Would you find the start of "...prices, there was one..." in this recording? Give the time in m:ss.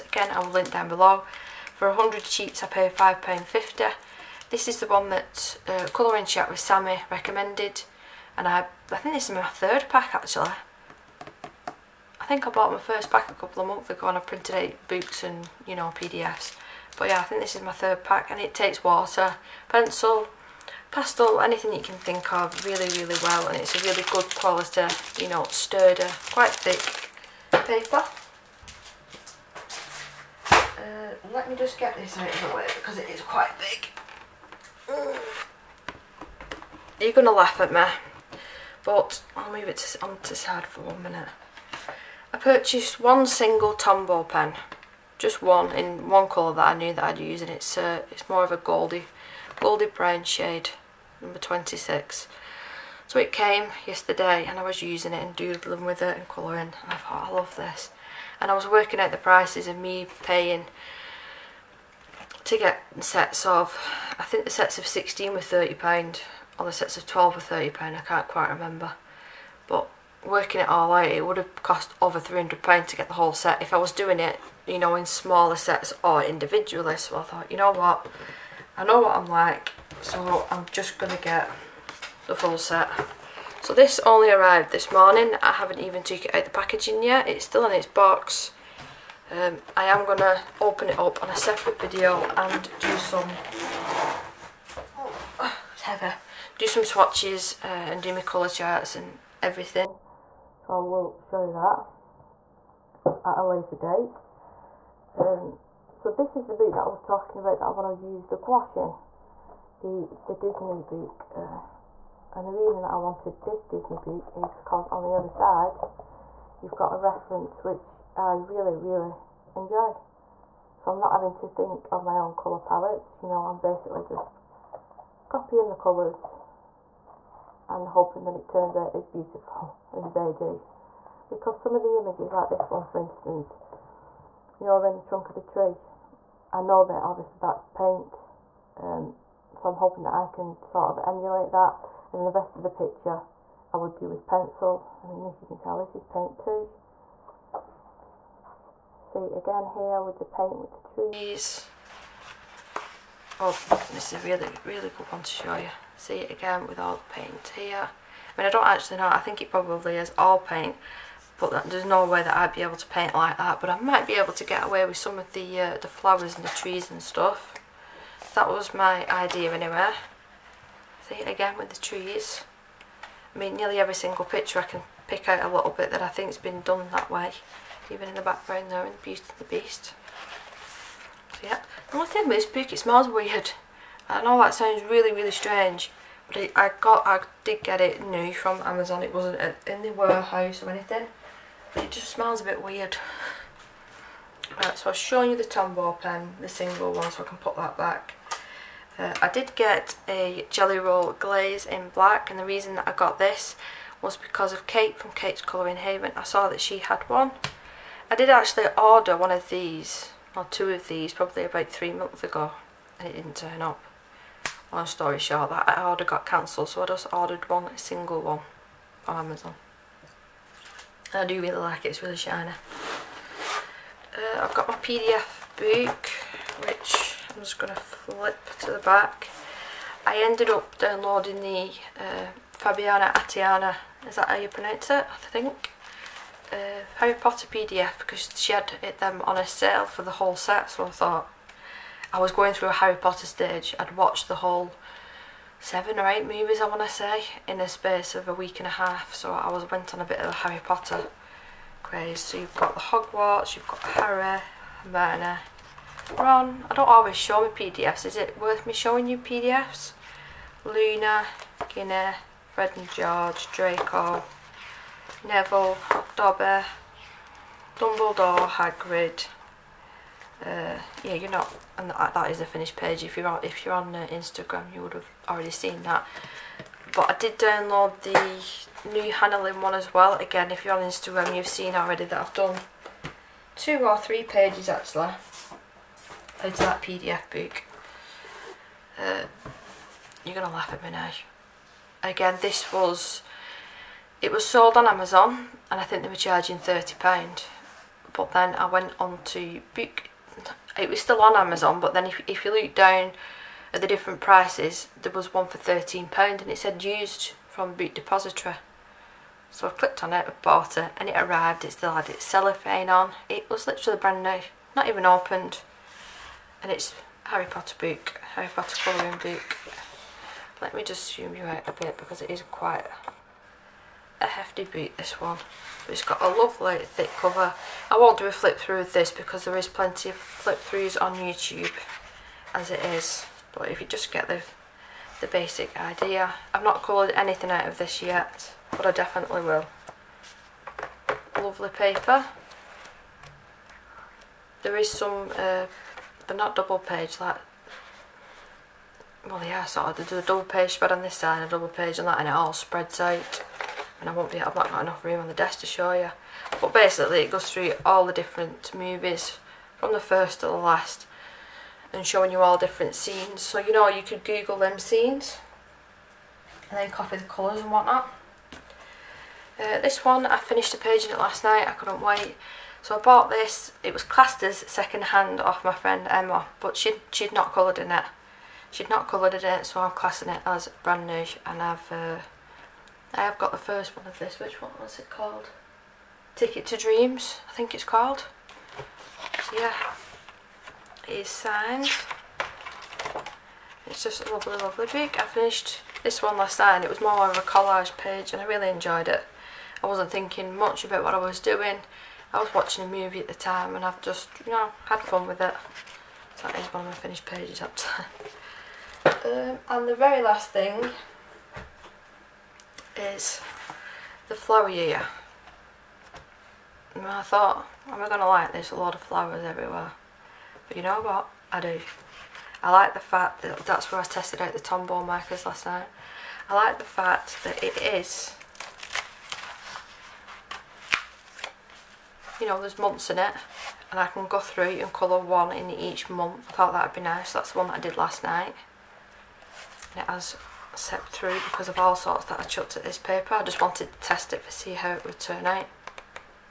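5:04.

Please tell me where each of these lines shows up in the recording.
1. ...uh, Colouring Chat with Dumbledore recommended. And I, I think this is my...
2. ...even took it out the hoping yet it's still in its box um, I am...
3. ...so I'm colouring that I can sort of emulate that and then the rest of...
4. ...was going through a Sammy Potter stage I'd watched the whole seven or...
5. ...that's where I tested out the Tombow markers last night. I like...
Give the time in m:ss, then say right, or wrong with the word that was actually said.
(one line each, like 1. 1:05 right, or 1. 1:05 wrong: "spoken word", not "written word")
1. 0:05 wrong: "Sammy", not "Dumbledore"
2. 1:25 wrong: "packaging", not "hoping"
3. 2:19 wrong: "hoping", not "colouring"
4. 4:02 wrong: "Harry", not "Sammy"
5. 7:03 right.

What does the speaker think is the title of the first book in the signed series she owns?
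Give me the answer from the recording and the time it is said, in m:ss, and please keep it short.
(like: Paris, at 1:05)
Ticket to Dreams, at 6:26.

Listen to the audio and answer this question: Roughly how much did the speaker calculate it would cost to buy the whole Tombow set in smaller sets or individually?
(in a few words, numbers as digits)
over £300.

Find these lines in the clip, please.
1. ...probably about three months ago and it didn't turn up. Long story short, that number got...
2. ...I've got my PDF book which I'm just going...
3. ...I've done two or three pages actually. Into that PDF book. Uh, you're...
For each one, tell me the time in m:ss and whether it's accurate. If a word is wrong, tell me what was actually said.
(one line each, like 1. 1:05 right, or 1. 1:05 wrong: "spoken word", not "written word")
1. 3:31 wrong: "order", not "number"
2. 3:44 right
3. 4:42 right.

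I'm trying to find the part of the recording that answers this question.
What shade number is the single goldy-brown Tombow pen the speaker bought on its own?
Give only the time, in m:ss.
0:51.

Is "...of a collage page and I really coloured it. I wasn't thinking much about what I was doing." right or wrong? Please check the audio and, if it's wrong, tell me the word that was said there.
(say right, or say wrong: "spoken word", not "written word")
wrong: "enjoyed", not "coloured".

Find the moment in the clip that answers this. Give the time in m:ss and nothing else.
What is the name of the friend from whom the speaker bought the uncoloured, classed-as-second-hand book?
6:16.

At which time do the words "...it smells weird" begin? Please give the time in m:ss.
3:02.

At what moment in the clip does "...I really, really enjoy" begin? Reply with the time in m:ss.
1:58.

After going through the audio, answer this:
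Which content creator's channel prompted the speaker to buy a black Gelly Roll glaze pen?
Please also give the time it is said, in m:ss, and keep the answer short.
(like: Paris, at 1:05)
Kate's Colouring Haven, at 3:25.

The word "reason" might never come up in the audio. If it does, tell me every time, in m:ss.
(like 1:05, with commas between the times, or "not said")
1:52, 3:22.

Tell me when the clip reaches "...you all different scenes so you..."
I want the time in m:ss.
6:02.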